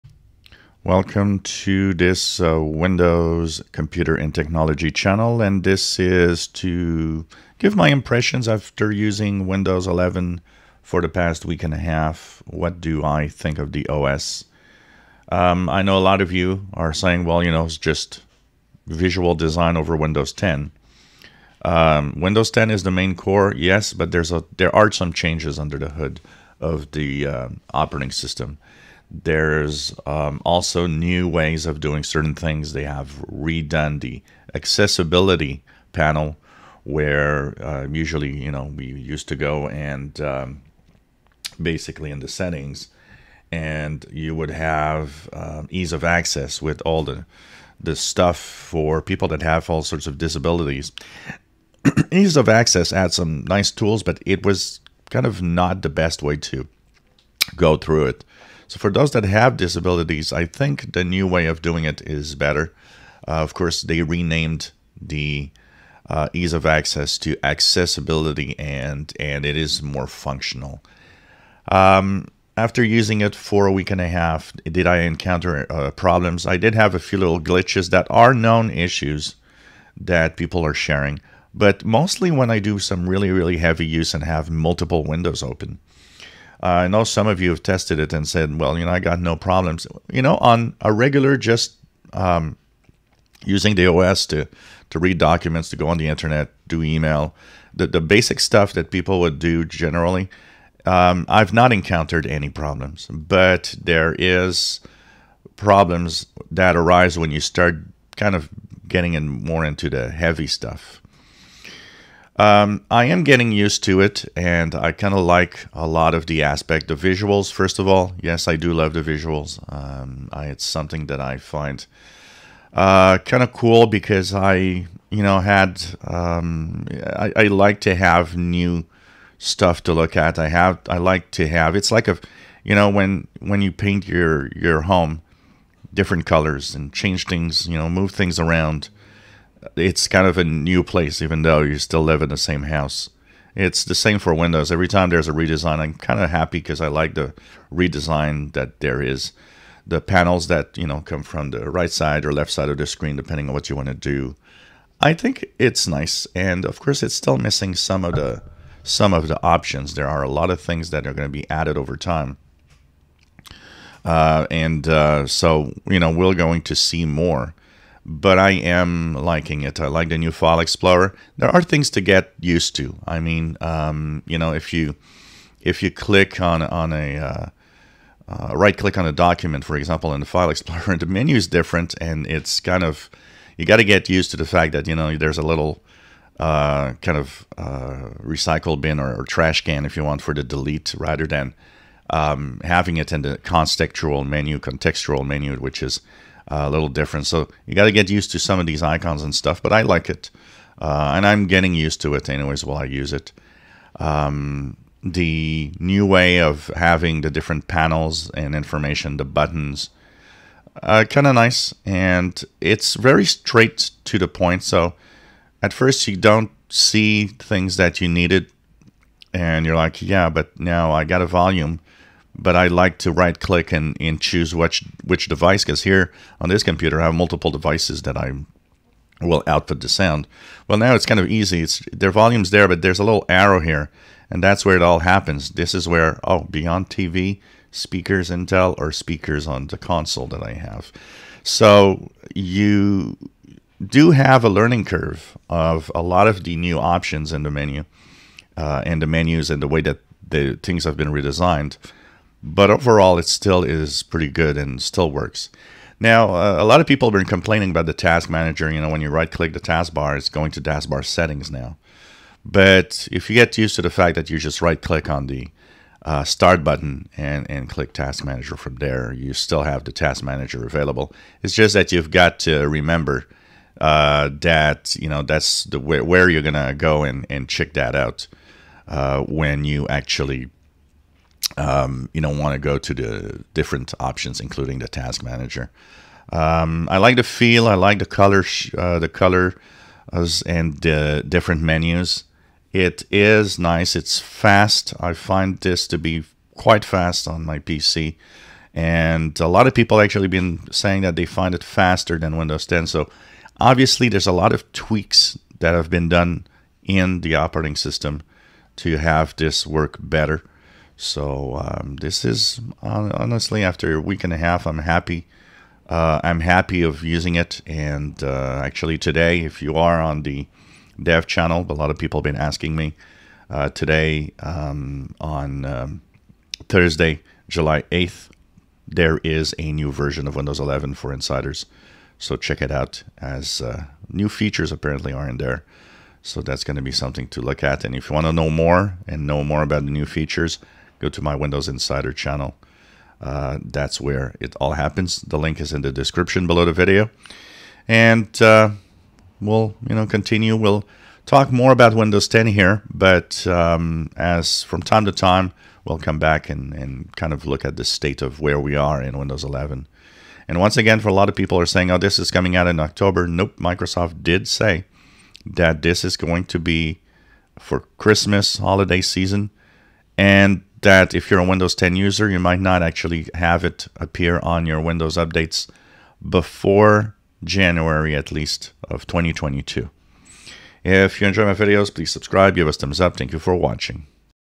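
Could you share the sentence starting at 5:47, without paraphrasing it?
And uh, we'll, you know, continue.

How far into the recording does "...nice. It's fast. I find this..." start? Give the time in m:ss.
4:53.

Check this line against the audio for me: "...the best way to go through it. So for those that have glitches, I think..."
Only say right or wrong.
wrong.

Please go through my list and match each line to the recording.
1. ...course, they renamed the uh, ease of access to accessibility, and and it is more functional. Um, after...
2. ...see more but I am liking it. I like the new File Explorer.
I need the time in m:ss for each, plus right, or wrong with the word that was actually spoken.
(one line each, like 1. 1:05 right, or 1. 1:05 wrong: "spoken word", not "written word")
1. 1:03 right
2. 2:46 right.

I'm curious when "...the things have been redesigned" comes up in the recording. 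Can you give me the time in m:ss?
4:10.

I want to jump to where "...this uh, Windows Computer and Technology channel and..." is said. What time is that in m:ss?
0:01.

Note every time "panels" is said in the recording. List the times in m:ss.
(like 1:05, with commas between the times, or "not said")
0:35, 2:29, 3:27.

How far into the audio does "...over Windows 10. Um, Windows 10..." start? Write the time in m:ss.
0:19.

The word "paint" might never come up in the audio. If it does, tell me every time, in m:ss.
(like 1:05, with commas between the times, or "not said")
2:13.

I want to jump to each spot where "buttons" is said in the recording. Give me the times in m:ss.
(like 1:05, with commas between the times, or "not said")
3:29, 4:26.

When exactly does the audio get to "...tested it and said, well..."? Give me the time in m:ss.
1:27.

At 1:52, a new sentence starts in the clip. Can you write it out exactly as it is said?
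Um, I am getting used to it, and I kind of like a lot of the aspect.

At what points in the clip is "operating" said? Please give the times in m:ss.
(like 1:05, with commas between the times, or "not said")
0:27, 5:07.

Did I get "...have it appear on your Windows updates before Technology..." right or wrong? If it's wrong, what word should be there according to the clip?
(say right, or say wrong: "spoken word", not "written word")
wrong: "January", not "Technology".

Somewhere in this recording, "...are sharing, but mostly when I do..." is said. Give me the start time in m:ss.
1:20.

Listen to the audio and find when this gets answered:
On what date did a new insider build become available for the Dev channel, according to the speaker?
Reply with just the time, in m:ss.
5:26.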